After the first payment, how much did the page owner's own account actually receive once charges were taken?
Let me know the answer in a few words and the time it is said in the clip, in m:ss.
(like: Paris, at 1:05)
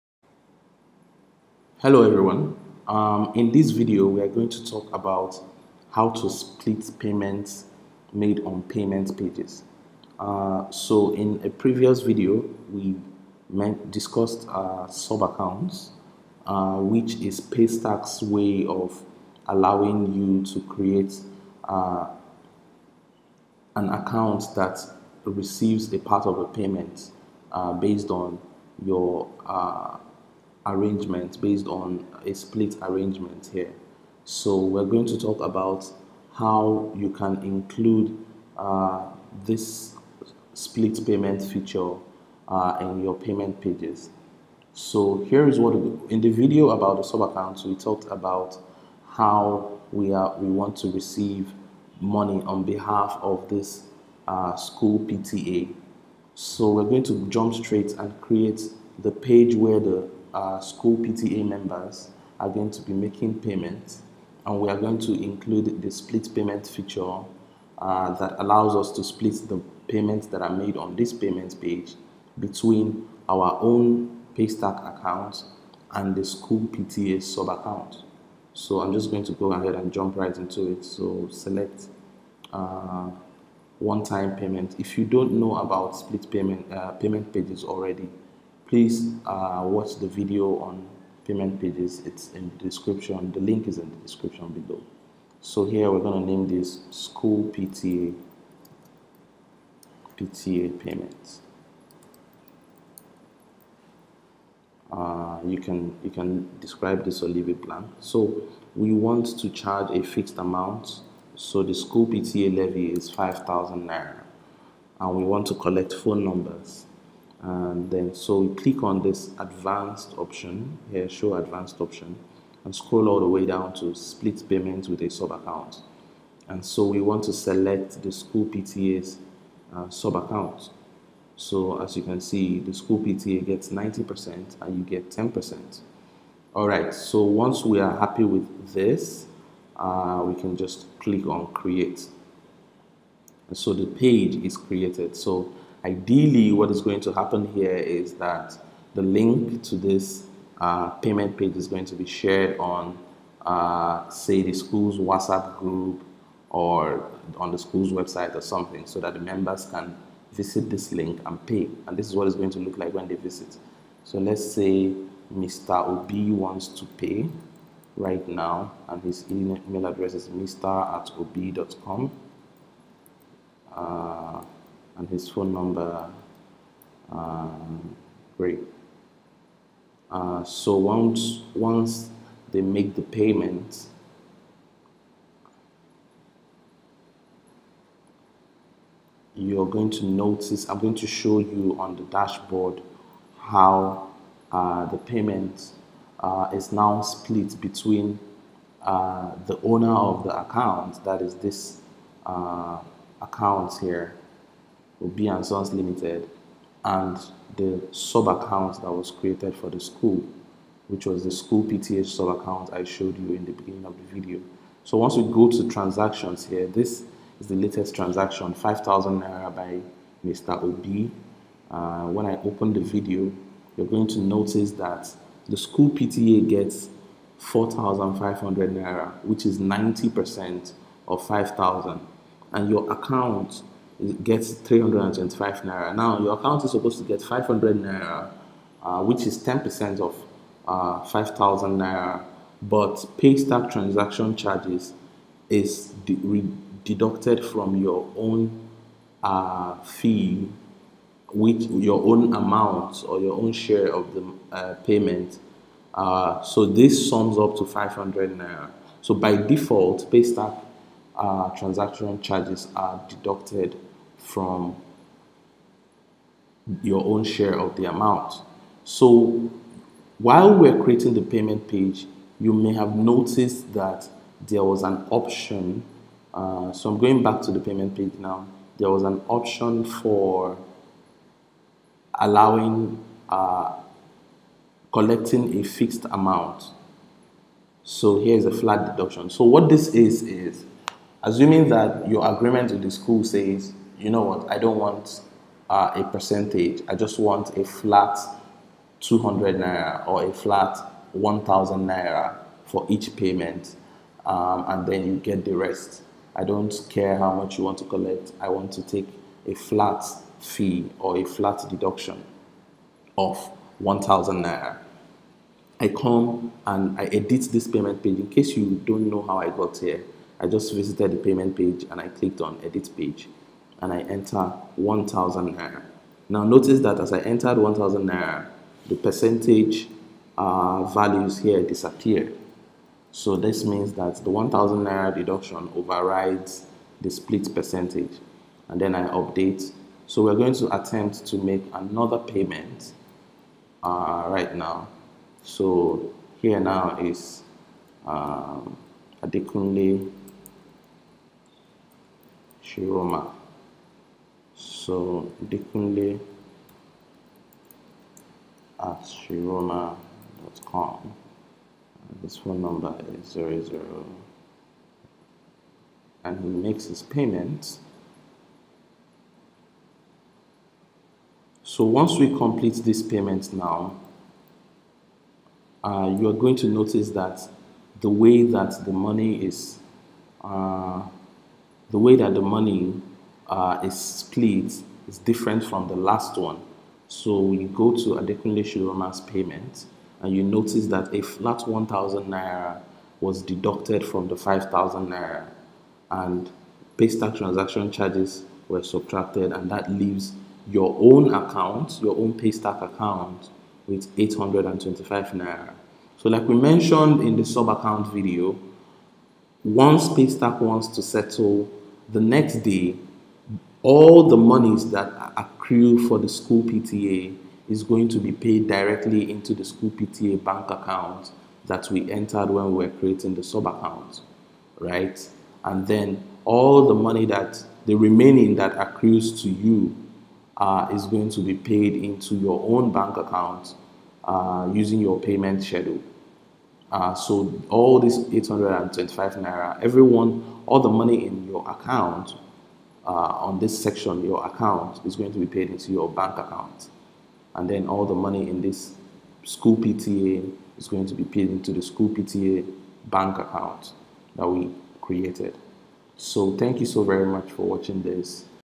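325 naira, at 3:54.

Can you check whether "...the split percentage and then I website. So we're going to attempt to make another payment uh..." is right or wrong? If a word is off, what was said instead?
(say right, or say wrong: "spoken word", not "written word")
wrong: "update", not "website".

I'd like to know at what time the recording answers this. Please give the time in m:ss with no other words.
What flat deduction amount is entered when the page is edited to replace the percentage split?
5:23.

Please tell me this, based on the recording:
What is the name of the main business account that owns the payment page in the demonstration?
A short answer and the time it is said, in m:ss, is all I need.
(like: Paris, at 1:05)
Obi and Sons Limited, at 3:25.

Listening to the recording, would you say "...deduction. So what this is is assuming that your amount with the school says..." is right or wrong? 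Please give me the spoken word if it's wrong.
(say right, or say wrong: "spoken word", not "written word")
wrong: "agreement", not "amount".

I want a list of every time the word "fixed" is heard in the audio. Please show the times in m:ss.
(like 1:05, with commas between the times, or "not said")
1:50, 4:45.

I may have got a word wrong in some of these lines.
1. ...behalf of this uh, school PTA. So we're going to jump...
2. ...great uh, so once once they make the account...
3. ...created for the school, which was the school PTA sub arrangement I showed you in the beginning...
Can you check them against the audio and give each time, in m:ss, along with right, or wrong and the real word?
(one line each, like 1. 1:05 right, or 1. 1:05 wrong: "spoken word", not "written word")
1. 0:52 right
2. 2:58 wrong: "payment", not "account"
3. 3:29 wrong: "account", not "arrangement".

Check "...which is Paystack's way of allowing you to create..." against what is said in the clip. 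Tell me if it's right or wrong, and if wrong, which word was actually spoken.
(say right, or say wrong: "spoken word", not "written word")
right.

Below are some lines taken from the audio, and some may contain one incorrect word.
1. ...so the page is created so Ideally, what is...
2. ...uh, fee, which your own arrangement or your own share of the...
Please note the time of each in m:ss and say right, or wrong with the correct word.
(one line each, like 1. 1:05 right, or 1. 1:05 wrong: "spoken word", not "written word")
1. 2:23 right
2. 4:09 wrong: "amount", not "arrangement".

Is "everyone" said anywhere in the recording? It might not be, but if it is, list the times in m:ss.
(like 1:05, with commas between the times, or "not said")
0:02, 7:19.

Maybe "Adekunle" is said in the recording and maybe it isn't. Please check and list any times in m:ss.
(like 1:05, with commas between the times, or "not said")
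5:49, 6:28.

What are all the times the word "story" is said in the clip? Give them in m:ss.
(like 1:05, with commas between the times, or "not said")
not said.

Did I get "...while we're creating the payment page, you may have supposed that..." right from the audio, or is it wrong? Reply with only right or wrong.
wrong.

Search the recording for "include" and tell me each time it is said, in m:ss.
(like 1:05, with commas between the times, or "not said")
0:37, 1:05.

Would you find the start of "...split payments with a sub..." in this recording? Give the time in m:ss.
2:03.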